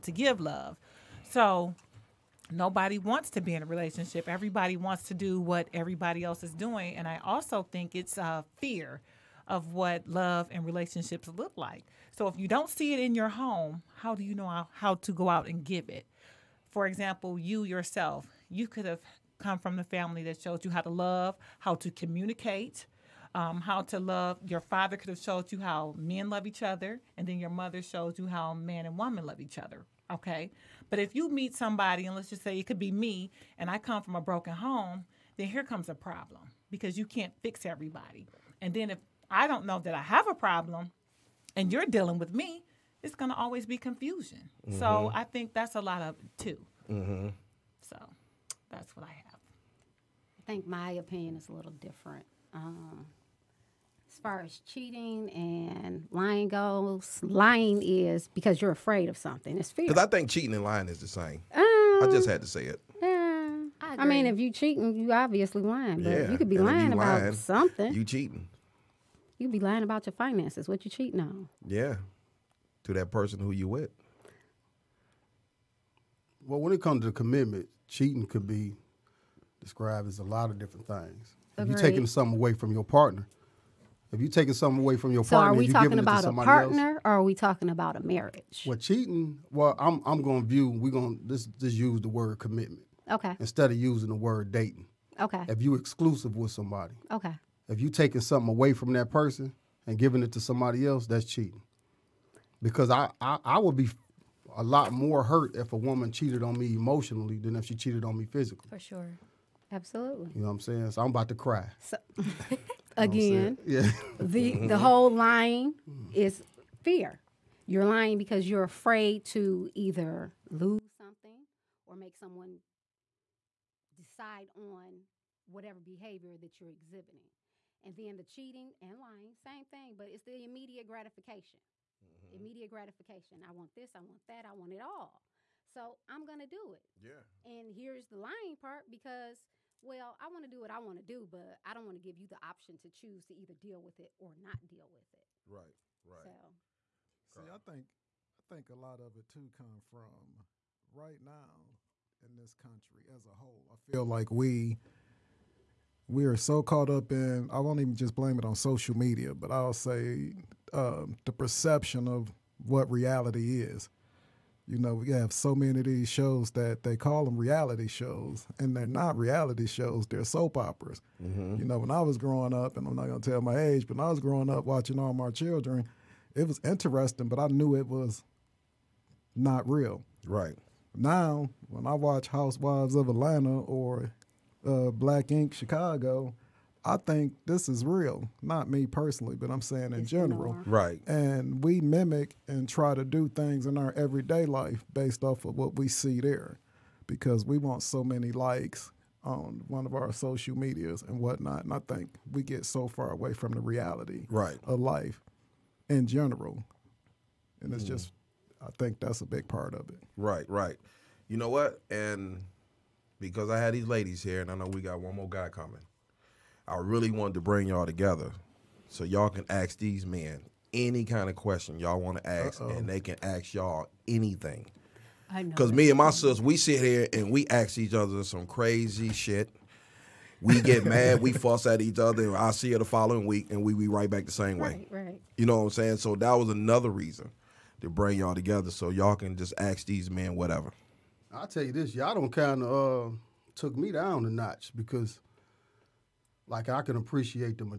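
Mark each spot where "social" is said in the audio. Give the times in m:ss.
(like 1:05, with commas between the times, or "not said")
2:38, 3:20.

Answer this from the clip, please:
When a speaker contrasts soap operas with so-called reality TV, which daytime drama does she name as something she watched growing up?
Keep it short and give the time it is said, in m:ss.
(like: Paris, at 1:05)
All My Children, at 2:54.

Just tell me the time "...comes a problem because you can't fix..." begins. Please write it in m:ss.
0:35.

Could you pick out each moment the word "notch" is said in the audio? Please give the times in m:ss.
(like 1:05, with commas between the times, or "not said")
4:04.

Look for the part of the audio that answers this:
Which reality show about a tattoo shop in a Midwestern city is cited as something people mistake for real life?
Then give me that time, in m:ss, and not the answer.
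3:04.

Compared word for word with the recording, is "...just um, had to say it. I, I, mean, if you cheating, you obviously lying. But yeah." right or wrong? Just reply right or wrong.
right.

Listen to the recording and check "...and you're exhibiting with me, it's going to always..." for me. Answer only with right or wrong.
wrong.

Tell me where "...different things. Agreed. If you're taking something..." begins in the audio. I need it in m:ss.
1:20.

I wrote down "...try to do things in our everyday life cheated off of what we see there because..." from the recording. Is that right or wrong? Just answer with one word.
wrong.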